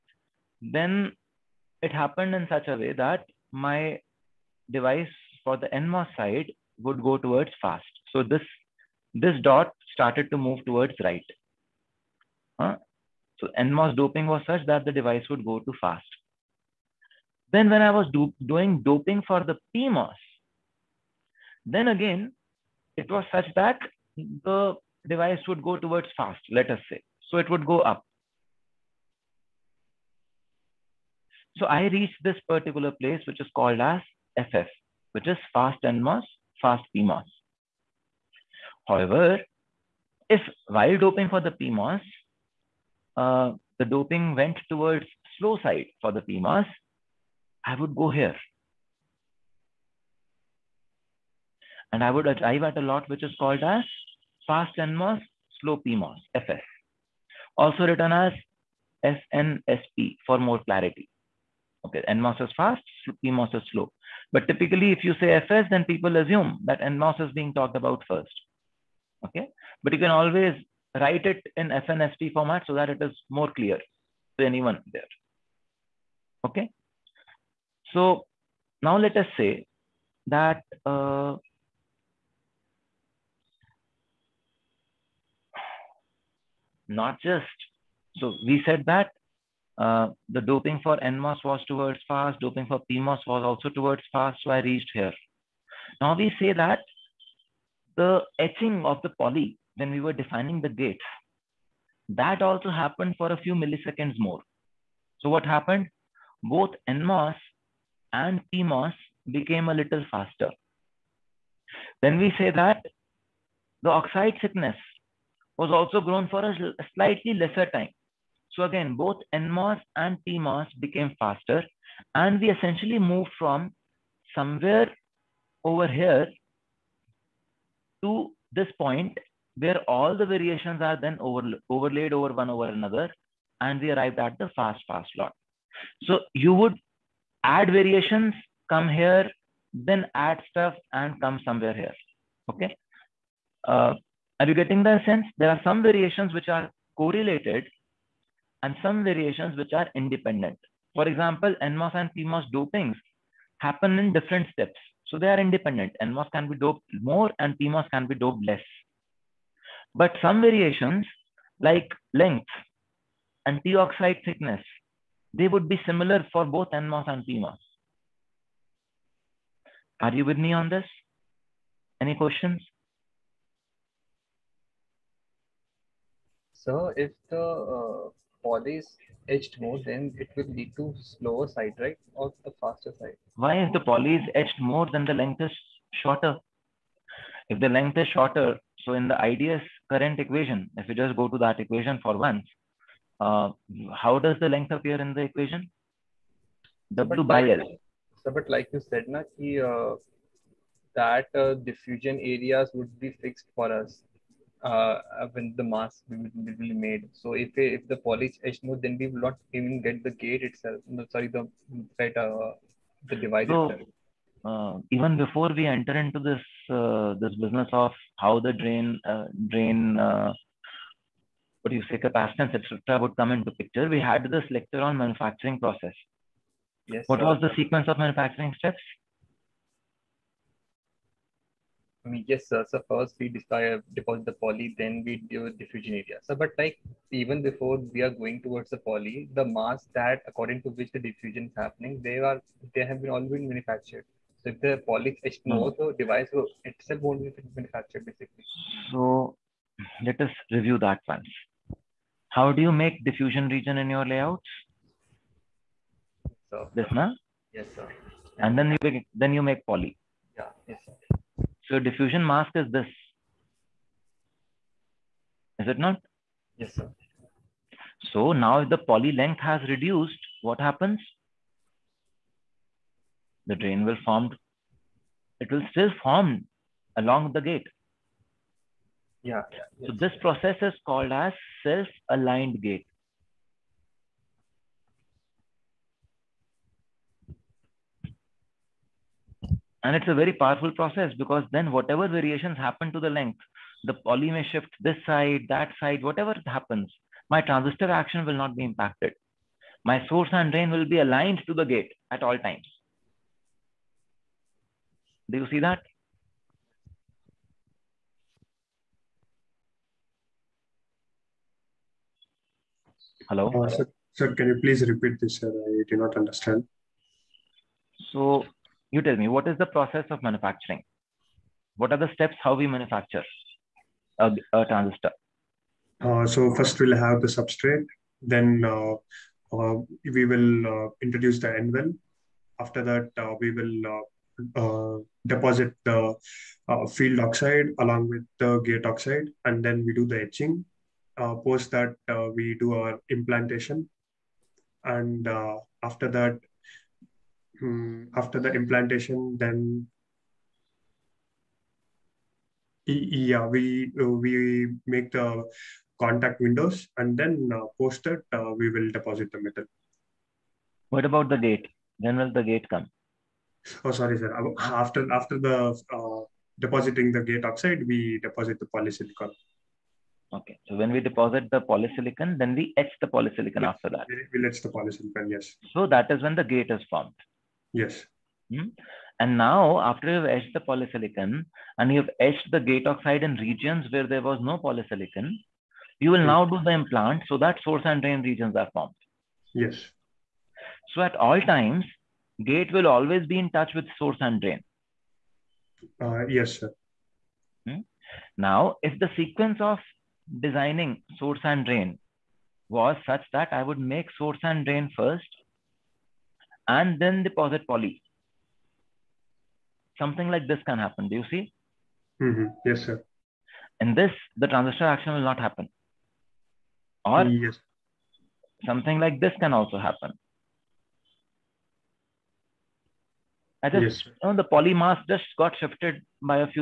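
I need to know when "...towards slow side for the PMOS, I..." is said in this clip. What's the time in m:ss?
0:44.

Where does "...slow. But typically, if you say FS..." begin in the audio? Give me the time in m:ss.
1:03.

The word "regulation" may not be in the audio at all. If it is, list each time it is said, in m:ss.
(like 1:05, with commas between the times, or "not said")
not said.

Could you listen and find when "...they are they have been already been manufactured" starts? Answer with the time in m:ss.
4:02.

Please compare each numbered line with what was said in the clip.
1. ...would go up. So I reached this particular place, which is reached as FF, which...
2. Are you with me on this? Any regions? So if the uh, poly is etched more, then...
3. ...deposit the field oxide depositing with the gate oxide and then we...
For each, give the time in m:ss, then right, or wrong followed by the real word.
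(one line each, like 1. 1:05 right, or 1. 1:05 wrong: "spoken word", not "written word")
1. 0:27 wrong: "called", not "reached"
2. 2:50 wrong: "questions", not "regions"
3. 5:35 wrong: "along", not "depositing".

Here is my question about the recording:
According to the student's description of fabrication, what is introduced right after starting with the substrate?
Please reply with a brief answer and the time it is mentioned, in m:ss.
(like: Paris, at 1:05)
n-well, at 5:31.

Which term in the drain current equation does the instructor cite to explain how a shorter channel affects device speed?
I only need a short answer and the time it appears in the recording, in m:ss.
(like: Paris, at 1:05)
W by L, at 3:16.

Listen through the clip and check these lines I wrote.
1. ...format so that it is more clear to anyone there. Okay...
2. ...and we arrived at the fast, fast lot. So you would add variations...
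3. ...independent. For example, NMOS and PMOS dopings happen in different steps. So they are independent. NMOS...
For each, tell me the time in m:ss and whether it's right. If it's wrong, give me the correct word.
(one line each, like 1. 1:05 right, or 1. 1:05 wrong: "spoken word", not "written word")
1. 1:12 right
2. 2:13 right
3. 2:29 right.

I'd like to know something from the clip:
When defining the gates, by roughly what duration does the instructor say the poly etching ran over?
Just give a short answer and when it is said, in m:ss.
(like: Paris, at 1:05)
A few milliseconds, at 1:43.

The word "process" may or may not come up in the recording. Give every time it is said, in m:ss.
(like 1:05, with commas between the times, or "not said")
3:45, 4:40, 4:50, 5:19.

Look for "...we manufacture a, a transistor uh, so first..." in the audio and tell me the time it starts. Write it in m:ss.
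5:22.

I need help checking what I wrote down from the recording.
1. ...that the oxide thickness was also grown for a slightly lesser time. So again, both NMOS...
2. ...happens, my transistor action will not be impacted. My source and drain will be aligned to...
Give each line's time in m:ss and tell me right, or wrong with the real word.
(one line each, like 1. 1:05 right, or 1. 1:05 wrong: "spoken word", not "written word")
1. 1:52 right
2. 4:56 right.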